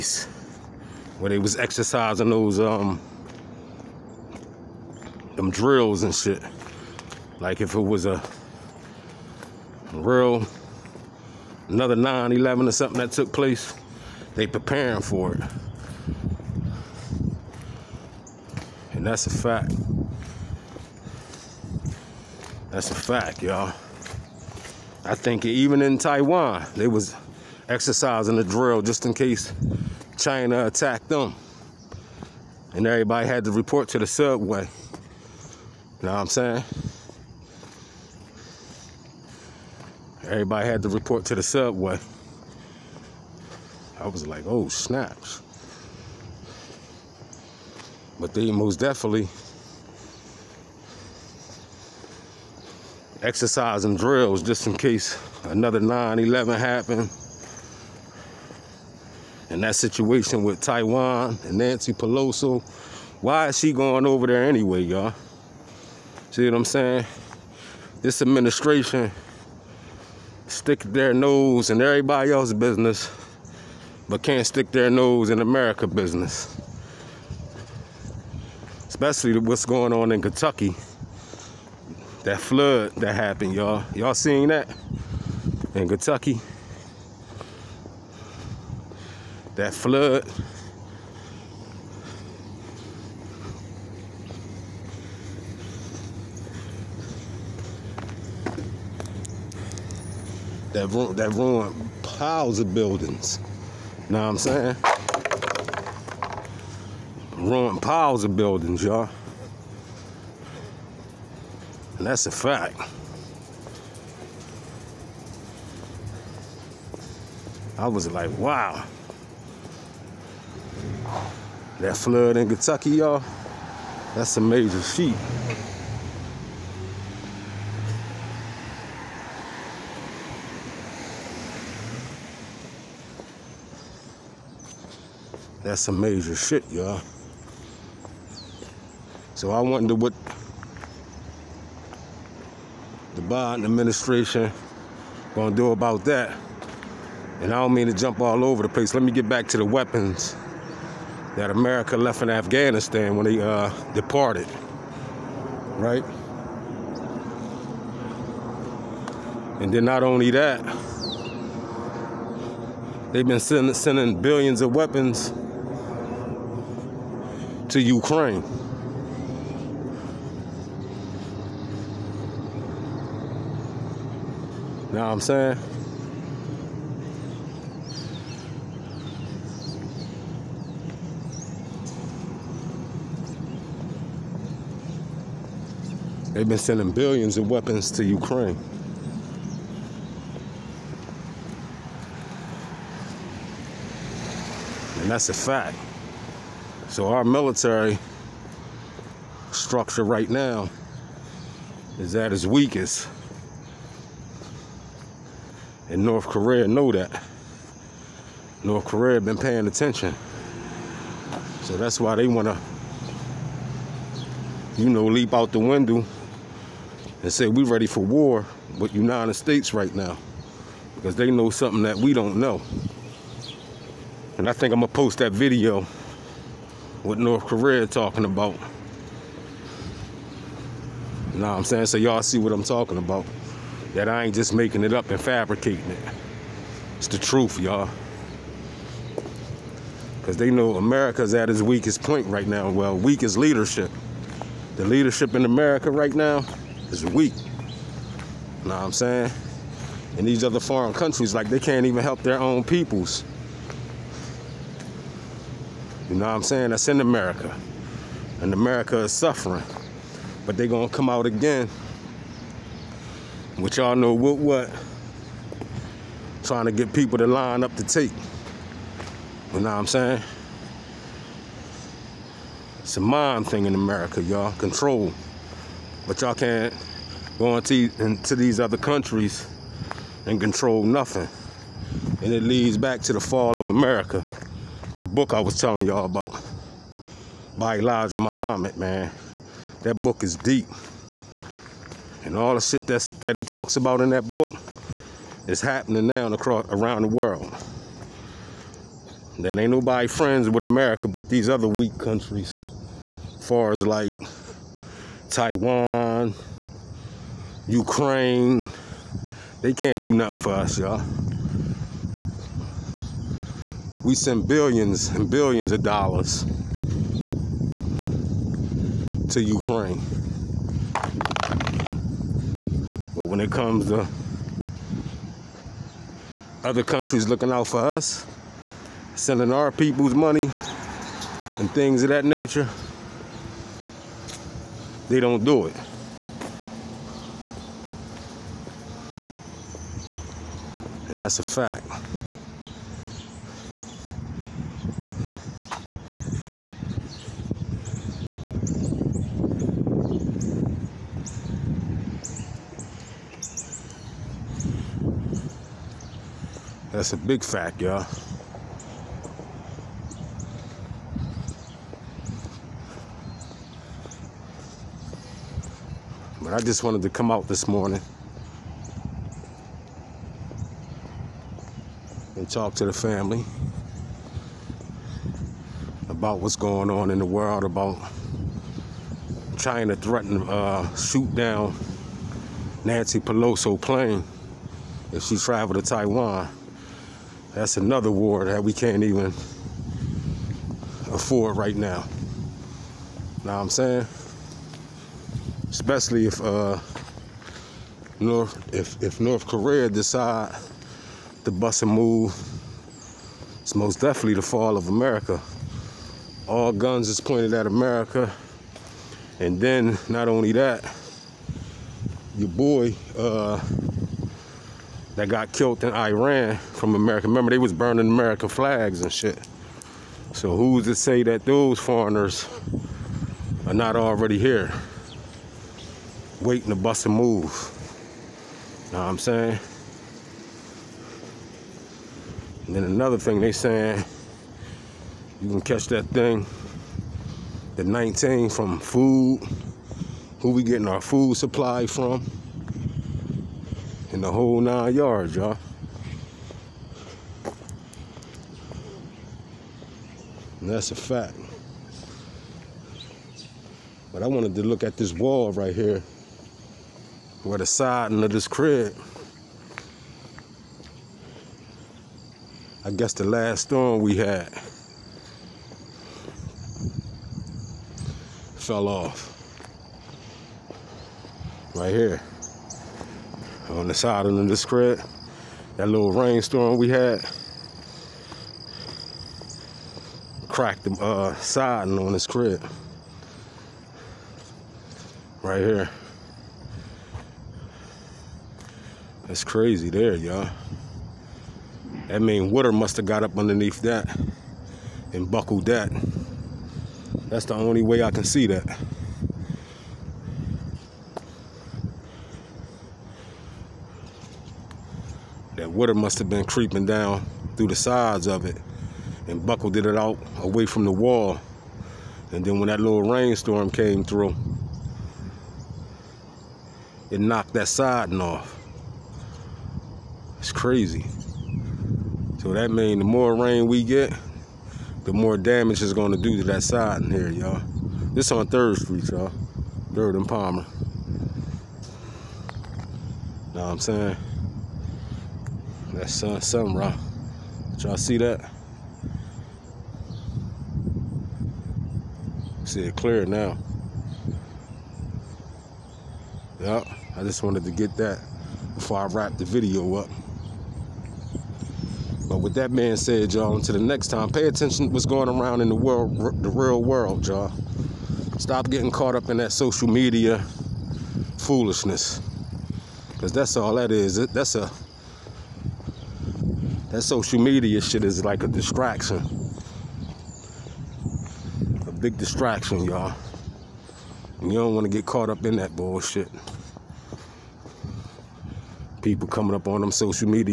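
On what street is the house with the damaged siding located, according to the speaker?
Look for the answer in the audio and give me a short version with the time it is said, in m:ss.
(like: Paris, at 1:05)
Third Street, at 8:48.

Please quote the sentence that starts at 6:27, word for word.
That's another war that we can't even afford right now.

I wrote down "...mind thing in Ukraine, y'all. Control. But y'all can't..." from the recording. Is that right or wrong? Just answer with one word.
wrong.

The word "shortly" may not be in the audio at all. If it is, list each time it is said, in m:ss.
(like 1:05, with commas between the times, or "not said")
not said.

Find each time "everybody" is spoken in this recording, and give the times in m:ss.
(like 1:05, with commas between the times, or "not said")
0:32, 0:40, 1:11.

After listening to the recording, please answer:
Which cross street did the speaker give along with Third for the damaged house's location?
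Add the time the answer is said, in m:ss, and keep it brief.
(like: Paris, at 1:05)
Palmer, at 8:50.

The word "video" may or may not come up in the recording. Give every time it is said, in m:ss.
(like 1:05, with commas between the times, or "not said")
3:45, 9:09.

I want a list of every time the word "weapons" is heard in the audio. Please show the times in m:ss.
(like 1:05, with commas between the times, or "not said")
2:29, 2:44, 3:07.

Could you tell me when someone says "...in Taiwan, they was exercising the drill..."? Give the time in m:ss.
0:25.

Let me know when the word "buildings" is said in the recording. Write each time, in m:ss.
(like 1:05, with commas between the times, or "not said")
1:42, 1:48.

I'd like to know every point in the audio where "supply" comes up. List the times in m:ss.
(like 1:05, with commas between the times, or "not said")
7:21.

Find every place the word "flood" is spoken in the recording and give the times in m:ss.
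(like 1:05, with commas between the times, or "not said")
1:22, 1:29, 2:01.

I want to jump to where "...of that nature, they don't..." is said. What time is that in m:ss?
5:32.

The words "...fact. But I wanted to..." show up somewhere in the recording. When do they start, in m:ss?
7:30.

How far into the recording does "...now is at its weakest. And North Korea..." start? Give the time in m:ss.
3:20.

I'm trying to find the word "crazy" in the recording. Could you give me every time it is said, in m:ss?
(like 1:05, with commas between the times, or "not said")
8:09, 8:40.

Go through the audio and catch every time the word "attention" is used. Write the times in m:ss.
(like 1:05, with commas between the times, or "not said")
3:29, 9:14.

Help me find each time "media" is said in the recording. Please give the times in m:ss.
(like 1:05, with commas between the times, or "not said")
9:19, 9:27.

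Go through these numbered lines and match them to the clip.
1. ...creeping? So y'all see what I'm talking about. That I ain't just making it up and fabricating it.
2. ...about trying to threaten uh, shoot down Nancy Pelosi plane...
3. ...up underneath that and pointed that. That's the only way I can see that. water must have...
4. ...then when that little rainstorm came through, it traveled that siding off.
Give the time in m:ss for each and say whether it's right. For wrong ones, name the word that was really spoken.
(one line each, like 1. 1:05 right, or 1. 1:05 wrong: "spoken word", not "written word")
1. 3:51 wrong: "saying", not "creeping"
2. 6:17 right
3. 8:13 wrong: "buckled", not "pointed"
4. 8:32 wrong: "knocked", not "traveled".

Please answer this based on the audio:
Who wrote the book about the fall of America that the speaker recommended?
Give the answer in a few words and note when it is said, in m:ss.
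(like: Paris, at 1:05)
Elijah Muhammad, at 4:47.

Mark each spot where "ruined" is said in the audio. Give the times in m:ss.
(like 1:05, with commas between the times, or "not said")
1:41, 1:47.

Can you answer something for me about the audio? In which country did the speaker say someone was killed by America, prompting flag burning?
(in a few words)
Iran.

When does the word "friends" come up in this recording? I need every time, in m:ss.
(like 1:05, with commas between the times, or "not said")
5:00.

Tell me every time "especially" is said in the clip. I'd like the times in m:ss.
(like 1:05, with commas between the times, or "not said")
1:18, 6:35.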